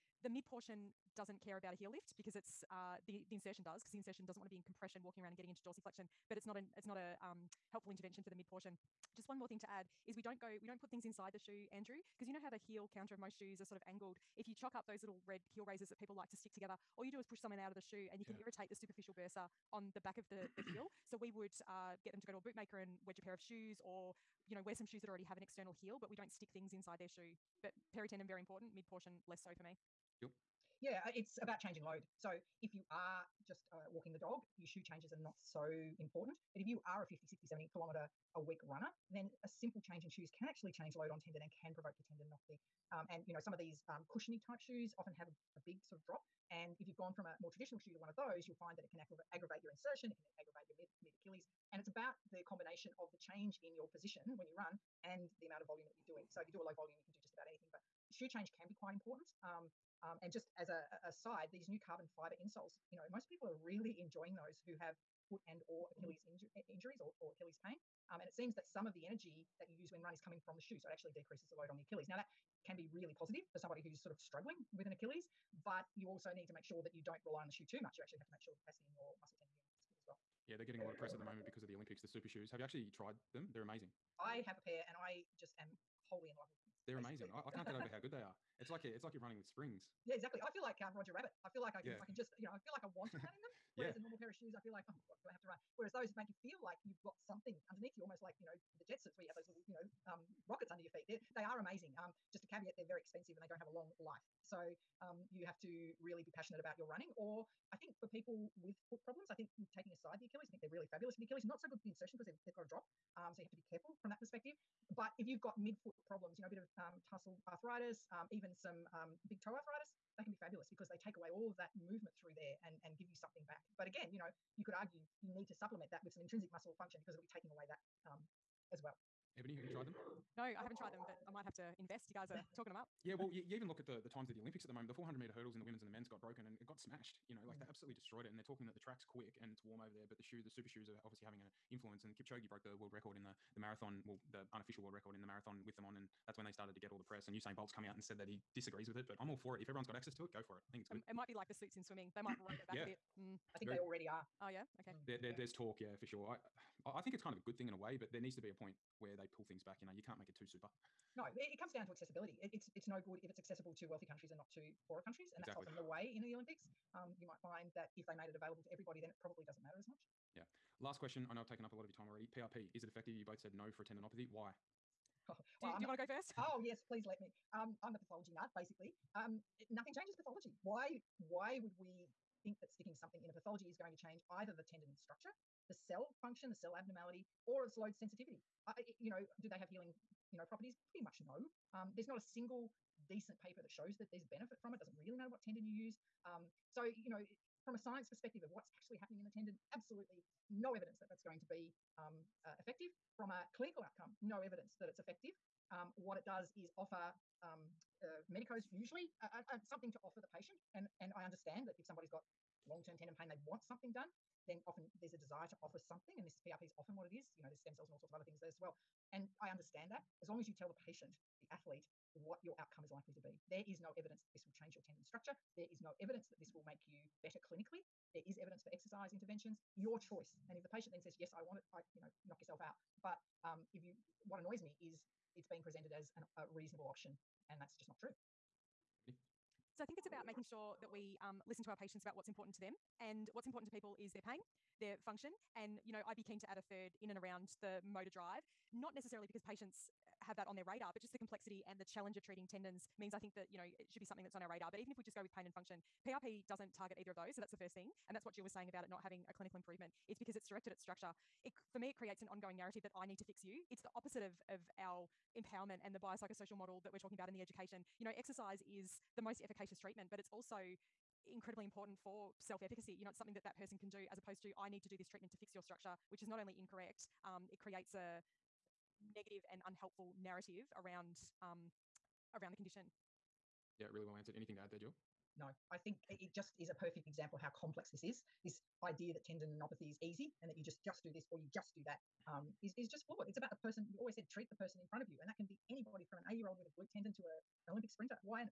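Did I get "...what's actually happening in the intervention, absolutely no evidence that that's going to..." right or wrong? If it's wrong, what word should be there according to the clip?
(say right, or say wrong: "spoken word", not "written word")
wrong: "tendon", not "intervention".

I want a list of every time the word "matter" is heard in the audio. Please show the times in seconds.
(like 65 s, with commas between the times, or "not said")
169 s, 195 s.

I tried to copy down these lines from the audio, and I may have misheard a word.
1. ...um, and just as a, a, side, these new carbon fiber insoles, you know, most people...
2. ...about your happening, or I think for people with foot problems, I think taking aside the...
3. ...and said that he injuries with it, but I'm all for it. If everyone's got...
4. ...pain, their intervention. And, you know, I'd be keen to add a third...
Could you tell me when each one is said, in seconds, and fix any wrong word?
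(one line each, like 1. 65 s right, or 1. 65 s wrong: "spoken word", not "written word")
1. 60 s right
2. 106 s wrong: "running", not "happening"
3. 147 s wrong: "disagrees", not "injuries"
4. 244 s wrong: "function", not "intervention".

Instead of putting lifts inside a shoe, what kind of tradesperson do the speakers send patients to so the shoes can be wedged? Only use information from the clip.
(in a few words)
bootmaker.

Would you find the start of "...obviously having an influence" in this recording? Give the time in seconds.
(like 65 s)
141 s.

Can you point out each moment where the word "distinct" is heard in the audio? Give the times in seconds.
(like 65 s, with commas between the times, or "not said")
not said.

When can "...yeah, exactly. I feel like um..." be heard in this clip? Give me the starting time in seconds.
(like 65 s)
90 s.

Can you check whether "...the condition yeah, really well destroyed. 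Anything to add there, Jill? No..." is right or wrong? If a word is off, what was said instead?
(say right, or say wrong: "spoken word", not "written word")
wrong: "answered", not "destroyed".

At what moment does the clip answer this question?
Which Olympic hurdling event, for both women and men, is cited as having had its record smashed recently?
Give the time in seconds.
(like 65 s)
134 s.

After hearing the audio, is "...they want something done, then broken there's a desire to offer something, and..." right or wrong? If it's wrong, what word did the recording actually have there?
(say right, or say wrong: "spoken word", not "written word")
wrong: "often", not "broken".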